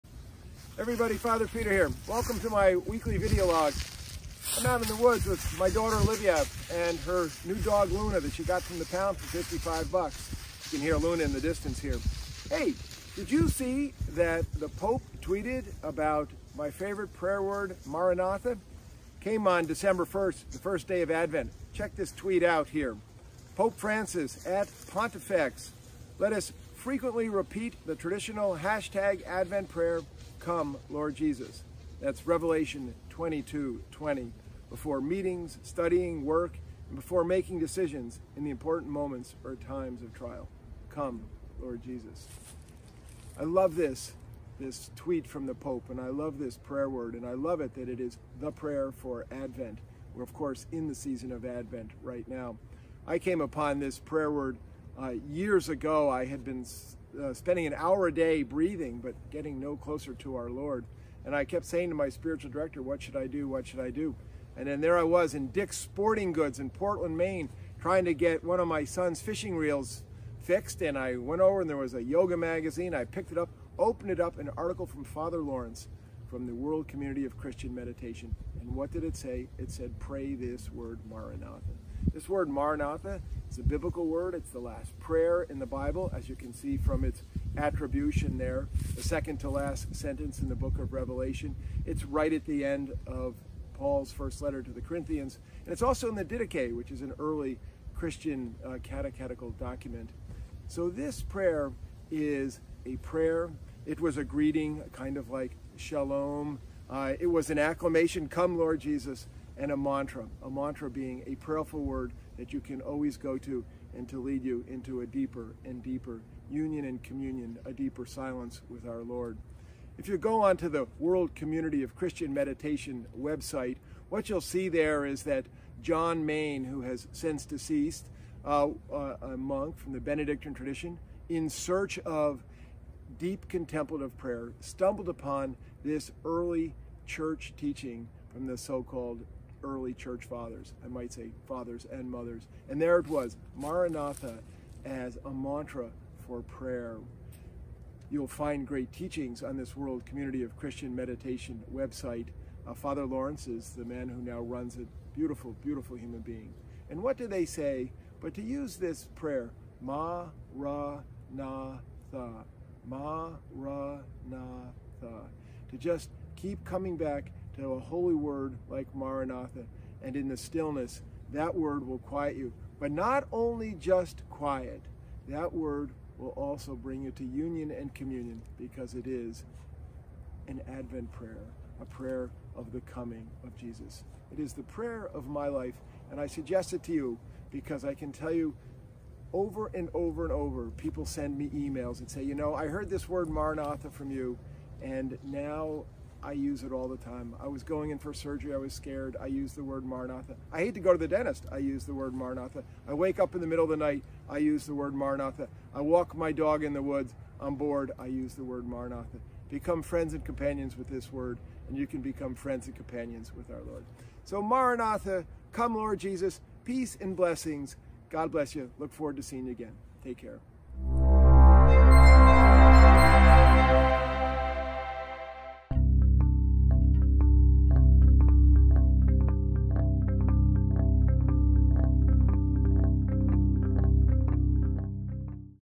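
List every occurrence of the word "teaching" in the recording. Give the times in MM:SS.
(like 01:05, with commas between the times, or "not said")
02:17, 02:28.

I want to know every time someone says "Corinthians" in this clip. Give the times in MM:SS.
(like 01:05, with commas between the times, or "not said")
01:34.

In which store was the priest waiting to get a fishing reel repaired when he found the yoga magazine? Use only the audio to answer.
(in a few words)
Dick's Sporting Goods.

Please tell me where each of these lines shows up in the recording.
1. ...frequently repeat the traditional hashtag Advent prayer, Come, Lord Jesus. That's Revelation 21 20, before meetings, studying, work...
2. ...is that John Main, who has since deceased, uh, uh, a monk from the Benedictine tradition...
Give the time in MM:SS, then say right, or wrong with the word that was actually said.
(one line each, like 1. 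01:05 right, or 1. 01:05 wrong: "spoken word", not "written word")
1. 00:26 wrong: "22", not "21"
2. 02:05 right.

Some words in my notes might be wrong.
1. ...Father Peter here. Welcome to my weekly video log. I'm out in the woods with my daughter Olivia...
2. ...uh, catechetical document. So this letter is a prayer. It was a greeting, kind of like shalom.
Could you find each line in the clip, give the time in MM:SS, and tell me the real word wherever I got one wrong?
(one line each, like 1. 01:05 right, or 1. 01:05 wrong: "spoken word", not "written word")
1. 00:01 right
2. 01:38 wrong: "prayer", not "letter".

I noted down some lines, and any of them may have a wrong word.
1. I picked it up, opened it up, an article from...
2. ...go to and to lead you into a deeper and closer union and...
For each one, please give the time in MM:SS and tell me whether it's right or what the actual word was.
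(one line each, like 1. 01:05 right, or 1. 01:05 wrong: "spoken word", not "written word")
1. 01:12 right
2. 01:53 wrong: "deeper", not "closer".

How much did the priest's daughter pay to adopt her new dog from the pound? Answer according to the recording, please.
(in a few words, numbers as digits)
$55.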